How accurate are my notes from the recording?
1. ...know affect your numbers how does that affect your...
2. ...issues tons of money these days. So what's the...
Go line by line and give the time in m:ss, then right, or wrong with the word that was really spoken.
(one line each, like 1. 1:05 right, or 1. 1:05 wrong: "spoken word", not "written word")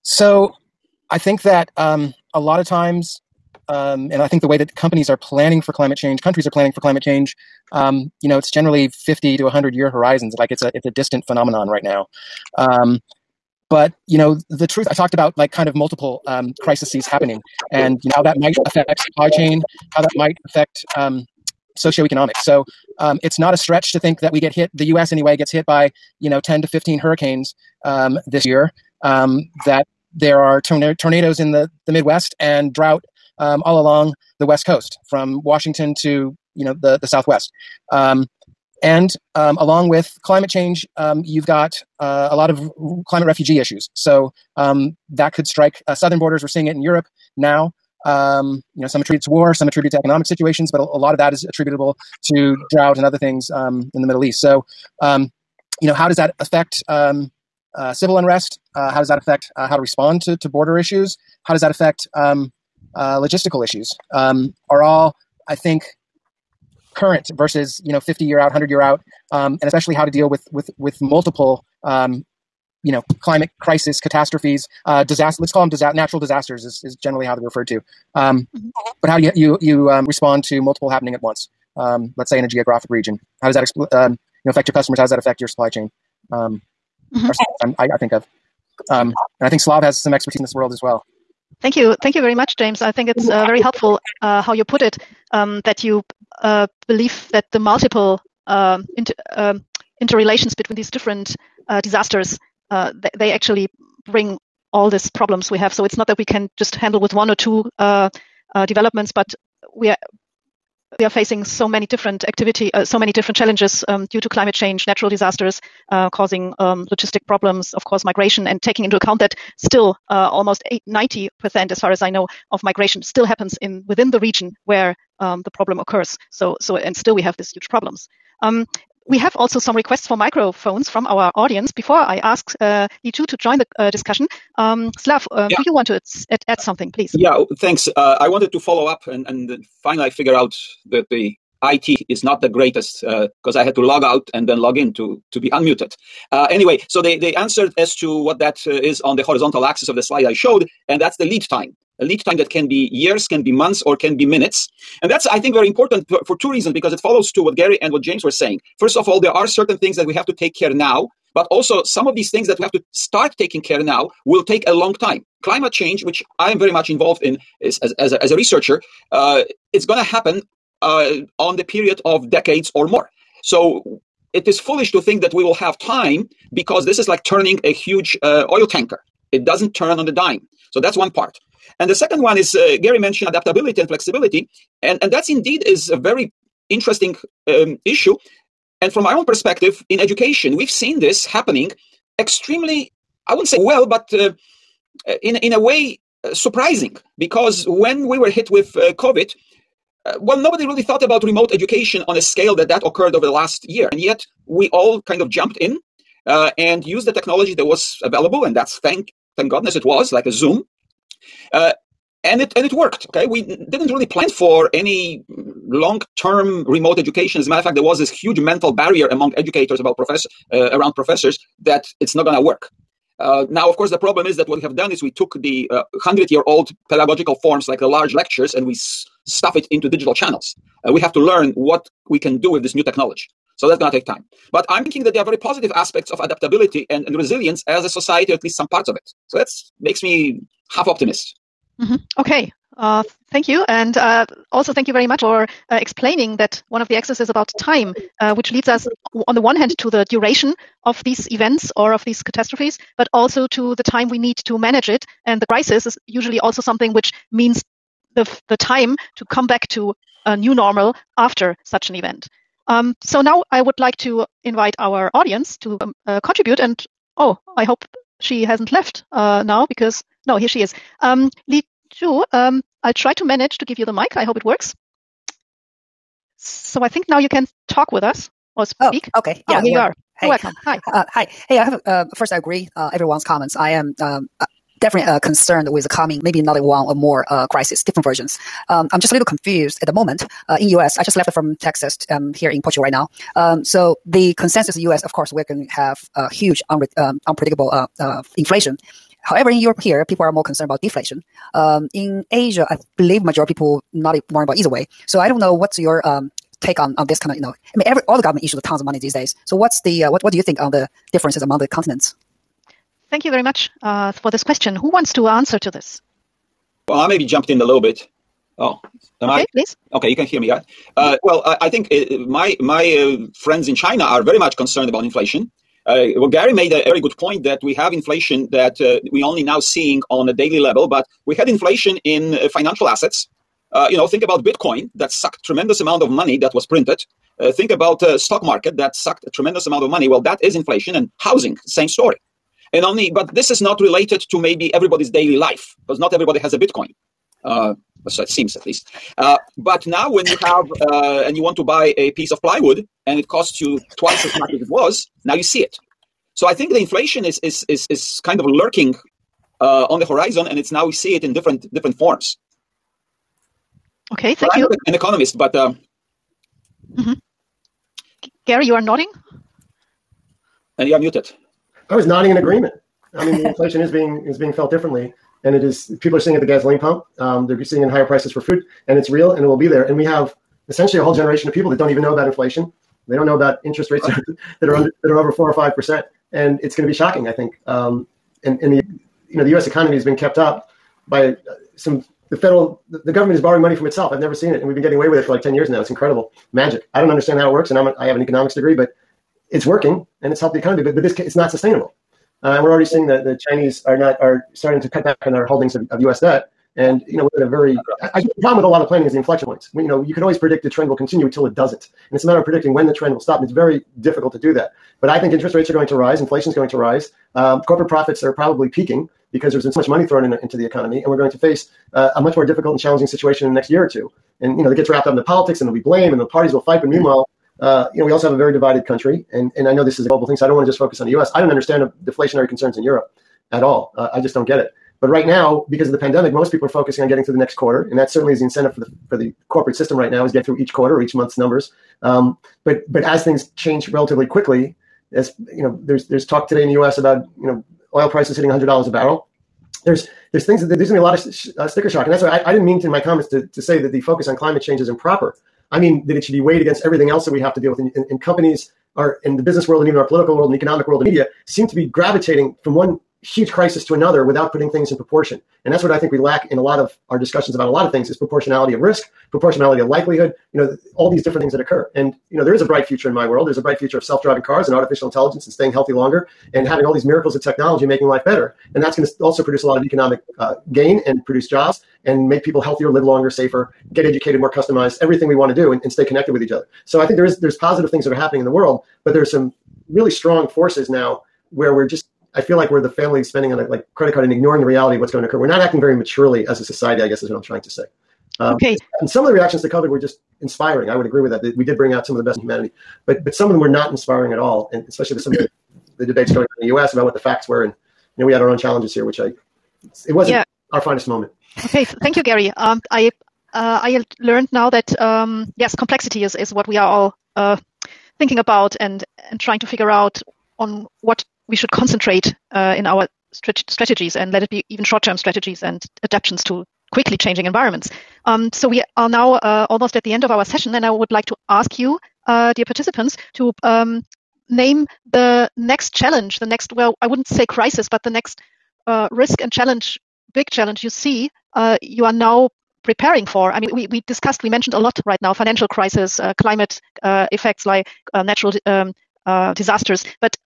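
1. 1:24 wrong: "customers", not "numbers"
2. 5:08 right.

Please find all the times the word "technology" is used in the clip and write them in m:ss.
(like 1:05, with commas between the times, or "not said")
3:27, 3:52, 7:57.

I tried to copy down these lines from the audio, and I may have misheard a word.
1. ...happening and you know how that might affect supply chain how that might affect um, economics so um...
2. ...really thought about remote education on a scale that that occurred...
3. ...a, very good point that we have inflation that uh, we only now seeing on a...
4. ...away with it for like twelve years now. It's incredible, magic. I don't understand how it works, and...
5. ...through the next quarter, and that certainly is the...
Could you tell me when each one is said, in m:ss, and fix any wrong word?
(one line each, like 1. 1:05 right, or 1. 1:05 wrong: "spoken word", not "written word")
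1. 0:17 wrong: "socioeconomics", not "economics"
2. 3:20 right
3. 5:26 right
4. 6:34 wrong: "ten", not "twelve"
5. 7:17 right.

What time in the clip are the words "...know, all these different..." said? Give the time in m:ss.
7:50.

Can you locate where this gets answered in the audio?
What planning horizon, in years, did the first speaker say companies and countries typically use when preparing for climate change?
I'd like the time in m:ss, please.
0:08.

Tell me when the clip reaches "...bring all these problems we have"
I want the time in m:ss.
1:44.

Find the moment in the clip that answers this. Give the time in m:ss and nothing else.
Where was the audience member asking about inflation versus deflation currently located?
4:52.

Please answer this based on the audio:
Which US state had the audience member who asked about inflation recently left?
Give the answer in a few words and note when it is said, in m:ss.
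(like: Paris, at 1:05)
Texas, at 4:51.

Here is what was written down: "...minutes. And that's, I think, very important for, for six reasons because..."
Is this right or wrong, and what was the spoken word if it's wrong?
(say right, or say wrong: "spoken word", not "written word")
wrong: "two", not "six".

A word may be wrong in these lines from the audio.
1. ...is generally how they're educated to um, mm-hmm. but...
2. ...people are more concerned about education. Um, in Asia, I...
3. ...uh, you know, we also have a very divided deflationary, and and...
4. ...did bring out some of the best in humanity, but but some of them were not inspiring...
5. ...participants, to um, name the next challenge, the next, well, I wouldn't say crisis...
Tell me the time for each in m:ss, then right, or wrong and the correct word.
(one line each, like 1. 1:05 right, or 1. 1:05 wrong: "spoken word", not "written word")
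1. 1:16 wrong: "referred", not "educated"
2. 5:00 wrong: "deflation", not "education"
3. 7:07 wrong: "country", not "deflationary"
4. 8:21 right
5. 8:52 right.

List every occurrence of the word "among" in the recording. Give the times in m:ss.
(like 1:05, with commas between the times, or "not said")
3:39, 5:11.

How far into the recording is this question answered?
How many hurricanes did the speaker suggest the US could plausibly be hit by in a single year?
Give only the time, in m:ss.
0:26.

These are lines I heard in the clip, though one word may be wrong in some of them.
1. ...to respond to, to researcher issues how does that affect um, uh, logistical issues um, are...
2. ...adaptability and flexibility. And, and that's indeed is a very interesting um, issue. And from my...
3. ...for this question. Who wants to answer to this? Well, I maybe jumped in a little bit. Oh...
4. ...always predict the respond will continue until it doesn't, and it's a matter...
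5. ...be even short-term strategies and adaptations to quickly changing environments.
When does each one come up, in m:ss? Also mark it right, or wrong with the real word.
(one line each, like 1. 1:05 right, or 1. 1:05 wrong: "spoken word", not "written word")
1. 0:59 wrong: "border", not "researcher"
2. 3:03 right
3. 5:14 right
4. 6:50 wrong: "trend", not "respond"
5. 8:44 right.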